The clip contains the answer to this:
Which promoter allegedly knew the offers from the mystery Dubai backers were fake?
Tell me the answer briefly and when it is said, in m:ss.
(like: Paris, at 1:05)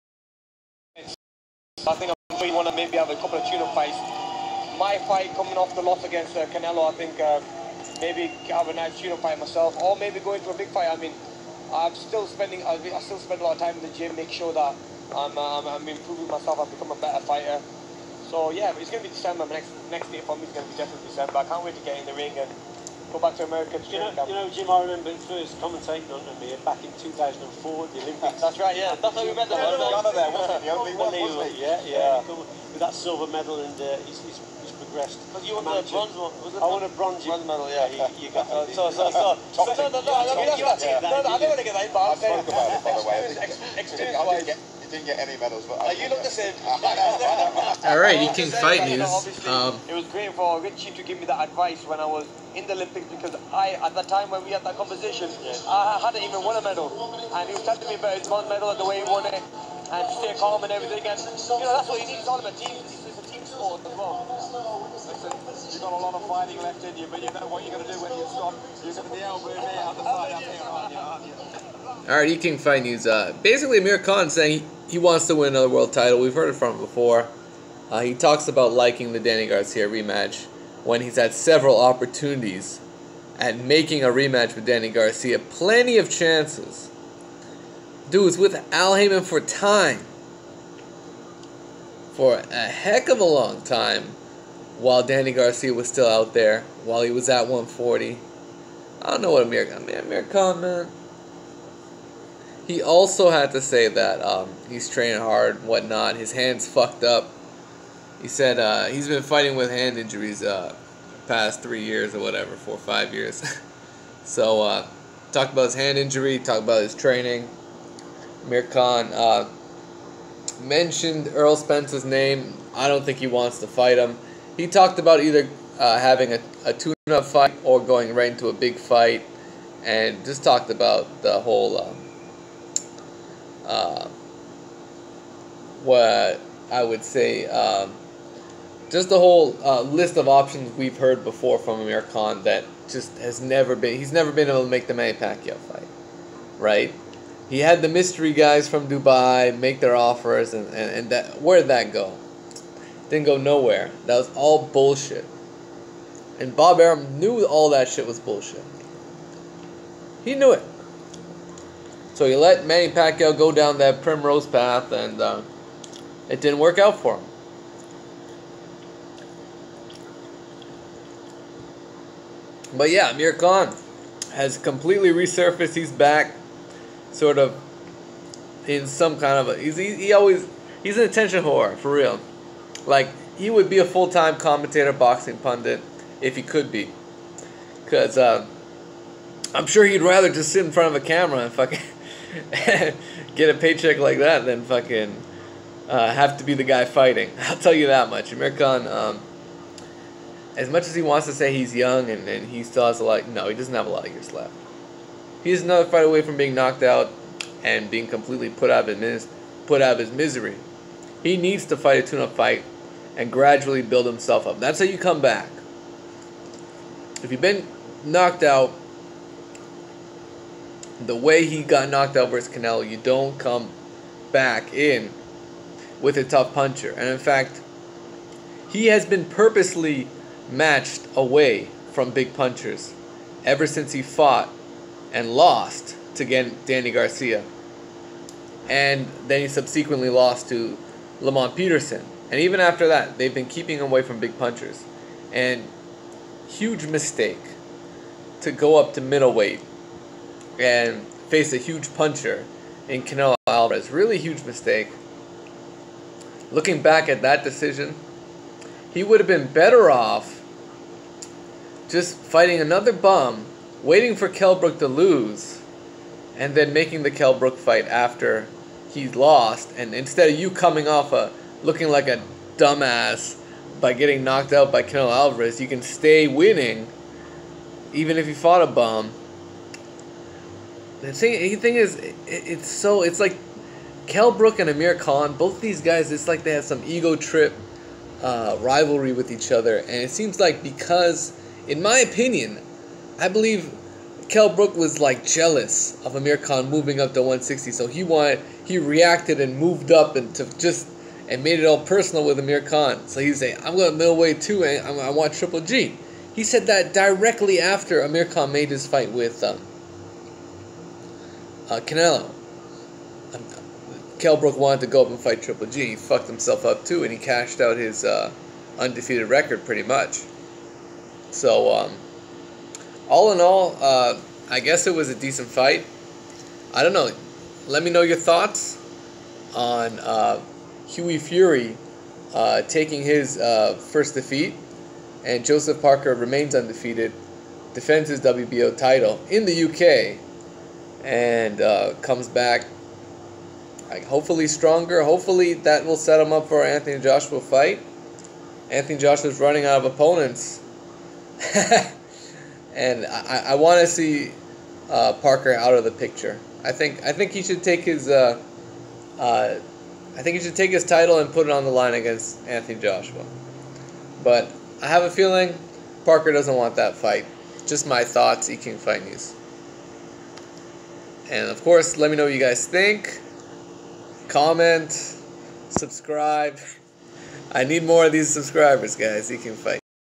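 Bob Arum, at 2:36.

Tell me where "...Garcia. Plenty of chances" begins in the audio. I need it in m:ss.
1:24.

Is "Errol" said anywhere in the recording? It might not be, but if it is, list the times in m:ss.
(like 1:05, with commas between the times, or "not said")
2:01.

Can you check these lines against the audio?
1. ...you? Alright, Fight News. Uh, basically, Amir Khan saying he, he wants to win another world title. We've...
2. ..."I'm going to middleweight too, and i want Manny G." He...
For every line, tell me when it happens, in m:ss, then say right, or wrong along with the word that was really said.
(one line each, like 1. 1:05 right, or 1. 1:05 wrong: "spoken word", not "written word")
1. 1:12 right
2. 5:03 wrong: "Triple", not "Manny".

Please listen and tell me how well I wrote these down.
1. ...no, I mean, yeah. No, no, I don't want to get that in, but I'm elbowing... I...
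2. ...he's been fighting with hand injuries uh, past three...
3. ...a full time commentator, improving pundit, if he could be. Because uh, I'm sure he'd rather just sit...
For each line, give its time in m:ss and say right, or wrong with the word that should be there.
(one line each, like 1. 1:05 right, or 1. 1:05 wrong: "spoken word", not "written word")
1. 0:39 wrong: "saying", not "elbowing"
2. 1:48 right
3. 3:03 wrong: "boxing", not "improving".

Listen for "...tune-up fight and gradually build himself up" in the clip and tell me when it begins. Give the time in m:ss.
3:32.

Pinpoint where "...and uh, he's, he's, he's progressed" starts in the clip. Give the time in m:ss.
0:33.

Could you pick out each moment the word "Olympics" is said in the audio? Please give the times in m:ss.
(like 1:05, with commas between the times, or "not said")
0:28, 0:52.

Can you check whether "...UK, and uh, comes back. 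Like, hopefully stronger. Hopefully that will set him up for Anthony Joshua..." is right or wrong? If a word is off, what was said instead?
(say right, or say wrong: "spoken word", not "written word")
right.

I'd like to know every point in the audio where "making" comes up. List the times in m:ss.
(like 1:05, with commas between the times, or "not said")
1:23, 4:26.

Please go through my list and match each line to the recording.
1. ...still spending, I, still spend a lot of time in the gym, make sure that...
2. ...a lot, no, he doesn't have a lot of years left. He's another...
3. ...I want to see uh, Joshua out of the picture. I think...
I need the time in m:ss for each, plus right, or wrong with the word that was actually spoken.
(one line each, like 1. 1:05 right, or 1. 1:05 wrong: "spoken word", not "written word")
1. 0:11 right
2. 3:22 right
3. 5:53 wrong: "Parker", not "Joshua".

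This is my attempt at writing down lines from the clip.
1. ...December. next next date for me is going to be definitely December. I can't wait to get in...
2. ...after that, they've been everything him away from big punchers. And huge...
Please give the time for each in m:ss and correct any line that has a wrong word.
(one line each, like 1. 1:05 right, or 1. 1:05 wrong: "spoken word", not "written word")
1. 0:19 right
2. 4:02 wrong: "keeping", not "everything".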